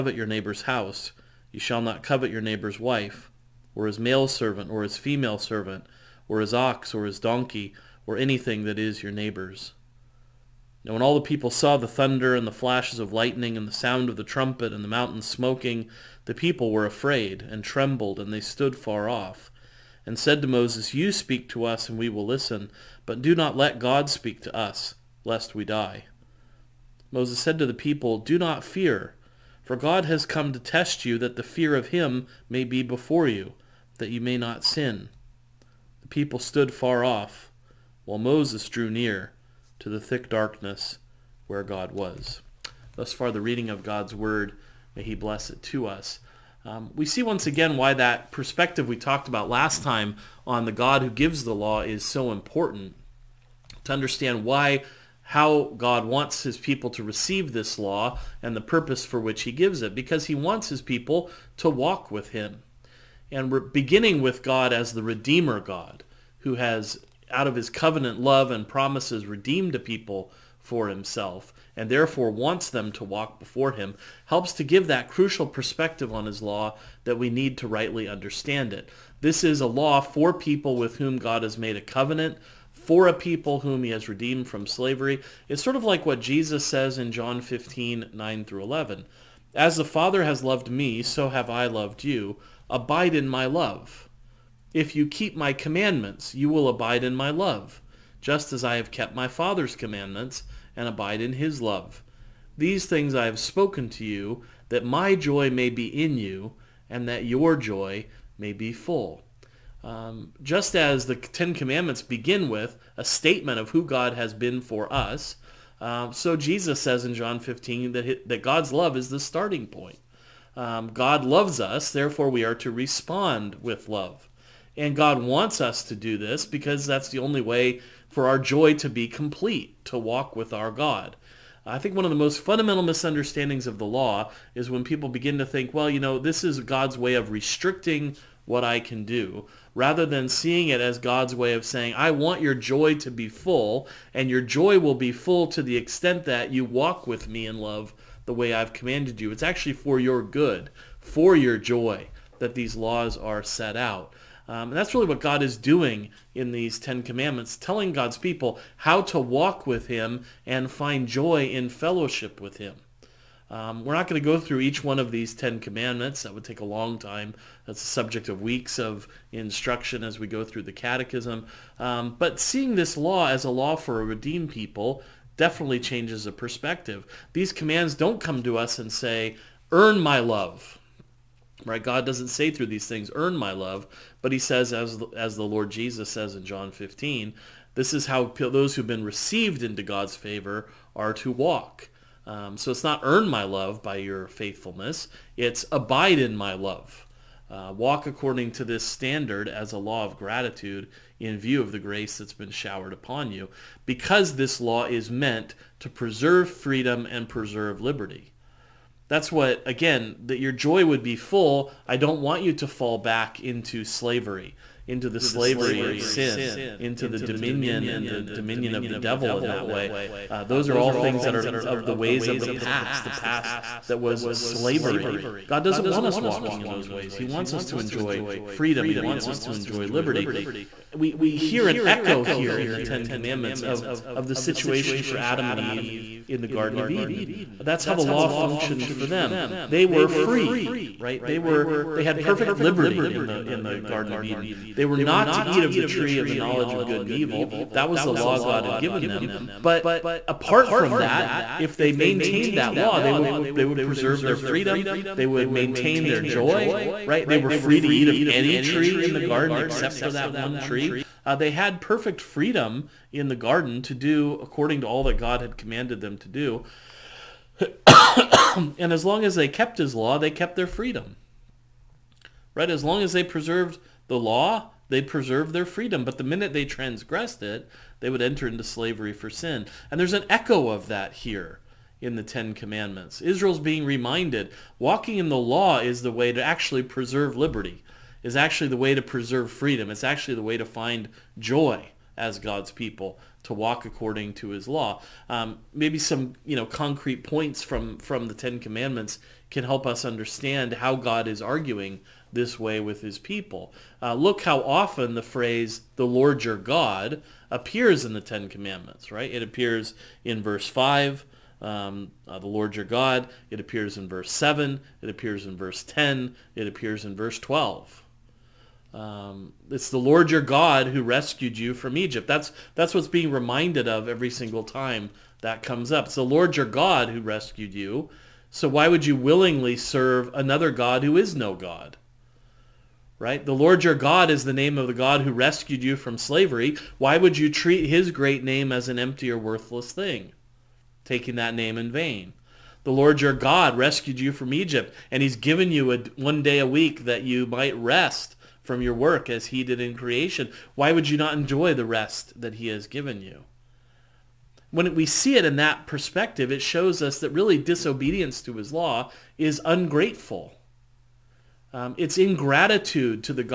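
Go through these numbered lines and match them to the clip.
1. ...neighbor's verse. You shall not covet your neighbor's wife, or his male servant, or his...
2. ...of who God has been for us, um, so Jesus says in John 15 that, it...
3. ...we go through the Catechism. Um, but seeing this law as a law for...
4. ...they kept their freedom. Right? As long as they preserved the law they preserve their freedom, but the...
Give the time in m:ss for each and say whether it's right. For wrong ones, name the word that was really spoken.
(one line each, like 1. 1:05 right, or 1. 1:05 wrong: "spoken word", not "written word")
1. 0:00 wrong: "house", not "verse"
2. 1:53 right
3. 2:50 right
4. 4:30 right.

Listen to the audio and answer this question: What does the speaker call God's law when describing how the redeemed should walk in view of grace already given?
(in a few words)
A law of gratitude.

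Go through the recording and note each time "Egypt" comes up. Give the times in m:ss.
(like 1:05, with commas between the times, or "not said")
5:21, 5:44.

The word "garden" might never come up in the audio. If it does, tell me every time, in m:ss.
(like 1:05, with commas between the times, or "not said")
3:56, 4:03, 4:19, 4:23.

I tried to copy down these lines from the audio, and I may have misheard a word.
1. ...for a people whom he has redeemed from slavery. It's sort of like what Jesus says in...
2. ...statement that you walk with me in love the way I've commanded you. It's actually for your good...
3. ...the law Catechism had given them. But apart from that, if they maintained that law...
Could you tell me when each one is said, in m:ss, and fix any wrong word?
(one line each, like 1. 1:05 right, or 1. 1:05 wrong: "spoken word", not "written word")
1. 1:22 right
2. 2:25 wrong: "extent", not "statement"
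3. 4:08 wrong: "God", not "Catechism".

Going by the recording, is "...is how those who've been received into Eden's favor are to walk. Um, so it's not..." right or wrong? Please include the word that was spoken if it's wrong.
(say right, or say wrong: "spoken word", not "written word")
wrong: "God", not "Eden".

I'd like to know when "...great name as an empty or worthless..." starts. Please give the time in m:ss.
5:38.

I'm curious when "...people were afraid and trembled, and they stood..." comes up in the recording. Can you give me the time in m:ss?
0:16.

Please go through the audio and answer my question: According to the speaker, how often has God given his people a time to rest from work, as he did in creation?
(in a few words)
One day a week.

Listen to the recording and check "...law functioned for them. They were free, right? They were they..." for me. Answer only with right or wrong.
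right.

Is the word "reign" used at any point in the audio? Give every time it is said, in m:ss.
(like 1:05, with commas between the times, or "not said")
not said.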